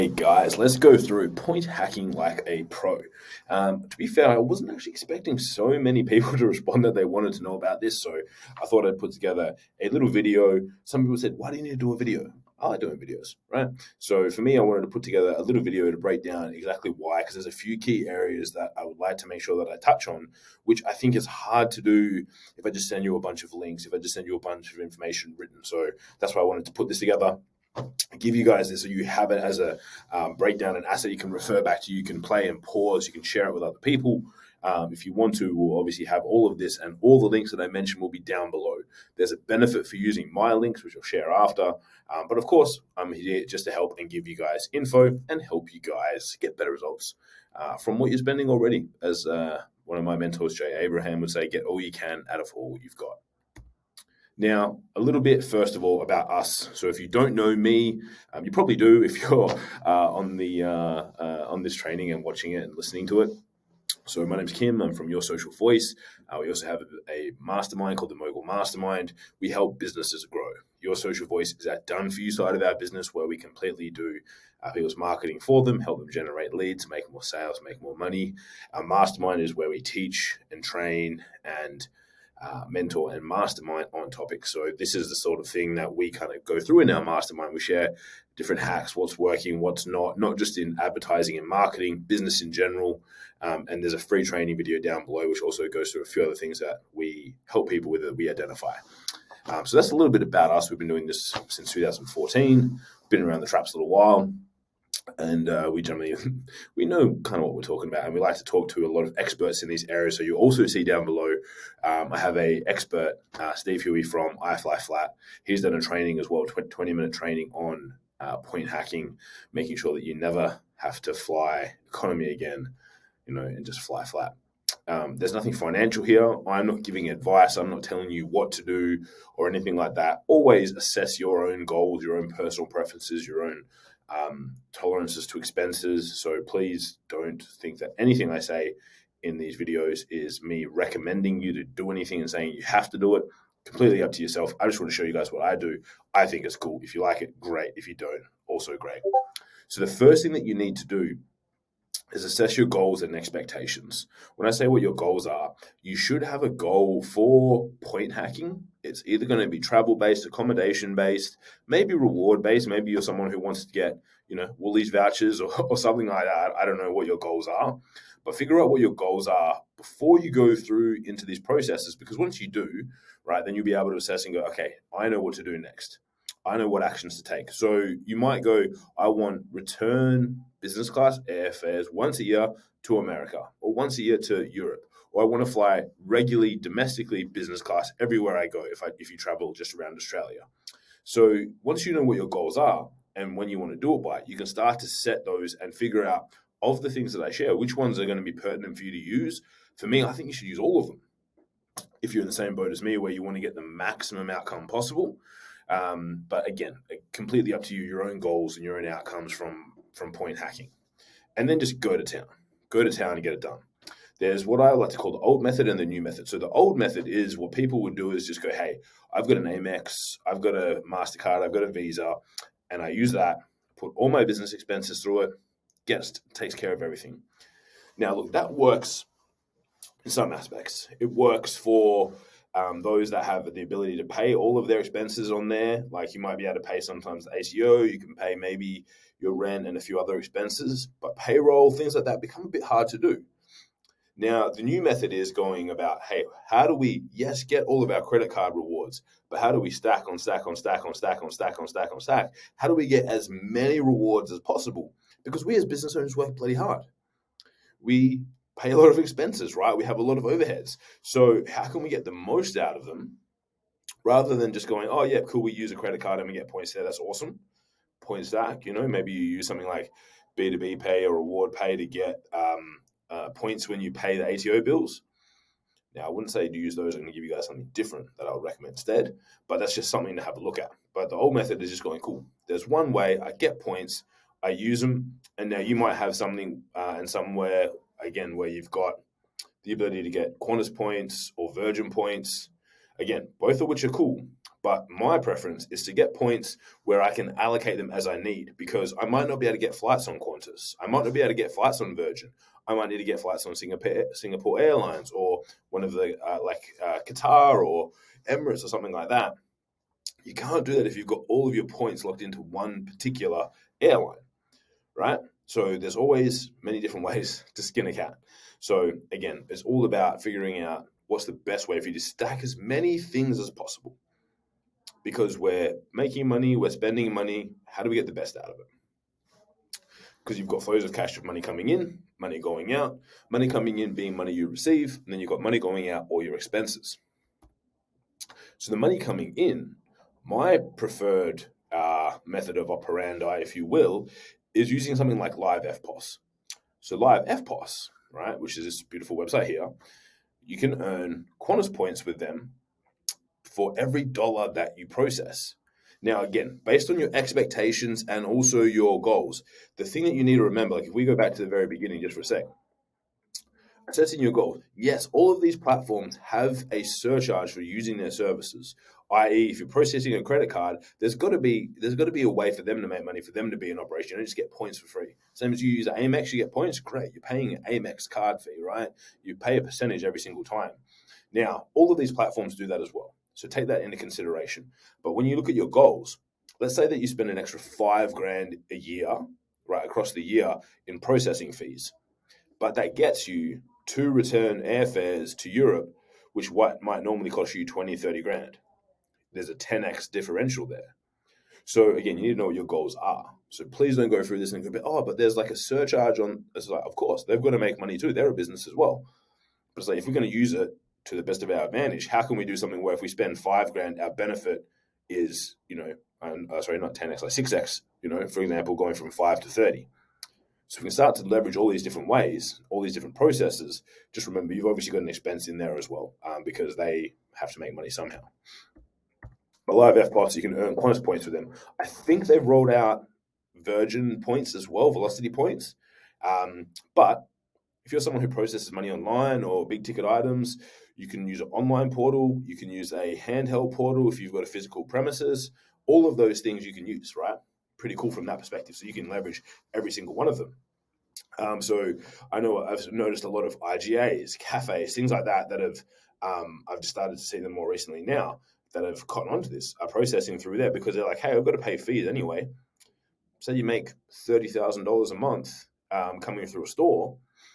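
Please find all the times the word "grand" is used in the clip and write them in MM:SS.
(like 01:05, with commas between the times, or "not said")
06:28, 06:38, 06:53.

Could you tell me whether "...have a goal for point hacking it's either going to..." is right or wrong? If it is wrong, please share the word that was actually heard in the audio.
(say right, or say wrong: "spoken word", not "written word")
right.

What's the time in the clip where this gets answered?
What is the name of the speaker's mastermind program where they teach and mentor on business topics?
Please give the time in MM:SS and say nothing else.
01:08.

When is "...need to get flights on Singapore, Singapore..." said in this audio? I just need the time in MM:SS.
05:02.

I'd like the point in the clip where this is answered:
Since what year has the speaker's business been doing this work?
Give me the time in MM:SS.
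01:41.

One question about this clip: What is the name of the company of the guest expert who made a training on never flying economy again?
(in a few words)
iFly Flat.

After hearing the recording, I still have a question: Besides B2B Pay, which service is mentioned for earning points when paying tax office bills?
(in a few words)
Reward Pay.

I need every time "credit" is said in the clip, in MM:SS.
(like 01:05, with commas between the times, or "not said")
04:08, 04:25, 06:10.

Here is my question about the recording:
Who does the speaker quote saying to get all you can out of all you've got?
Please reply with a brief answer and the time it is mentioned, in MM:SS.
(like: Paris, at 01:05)
Jay Abraham, at 00:50.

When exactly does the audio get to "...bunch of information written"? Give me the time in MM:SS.
00:24.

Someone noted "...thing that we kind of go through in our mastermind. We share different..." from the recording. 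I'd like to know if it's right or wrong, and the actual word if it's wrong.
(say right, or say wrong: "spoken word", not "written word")
right.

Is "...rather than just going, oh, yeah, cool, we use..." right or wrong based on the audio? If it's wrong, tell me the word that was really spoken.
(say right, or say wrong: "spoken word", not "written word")
right.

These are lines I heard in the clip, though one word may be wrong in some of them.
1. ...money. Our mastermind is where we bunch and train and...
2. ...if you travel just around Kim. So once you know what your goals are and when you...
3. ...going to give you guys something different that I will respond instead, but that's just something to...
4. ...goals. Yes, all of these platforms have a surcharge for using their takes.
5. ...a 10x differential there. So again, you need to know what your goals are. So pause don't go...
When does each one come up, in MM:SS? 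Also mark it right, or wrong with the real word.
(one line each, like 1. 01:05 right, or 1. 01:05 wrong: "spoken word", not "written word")
1. 01:17 wrong: "teach", not "bunch"
2. 03:08 wrong: "Australia", not "Kim"
3. 04:36 wrong: "recommend", not "respond"
4. 06:04 wrong: "services", not "takes"
5. 06:39 wrong: "please", not "pause".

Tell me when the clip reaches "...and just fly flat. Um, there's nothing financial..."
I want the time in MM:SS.
02:03.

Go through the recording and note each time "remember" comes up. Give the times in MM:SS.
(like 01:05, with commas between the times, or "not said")
06:00, 07:04.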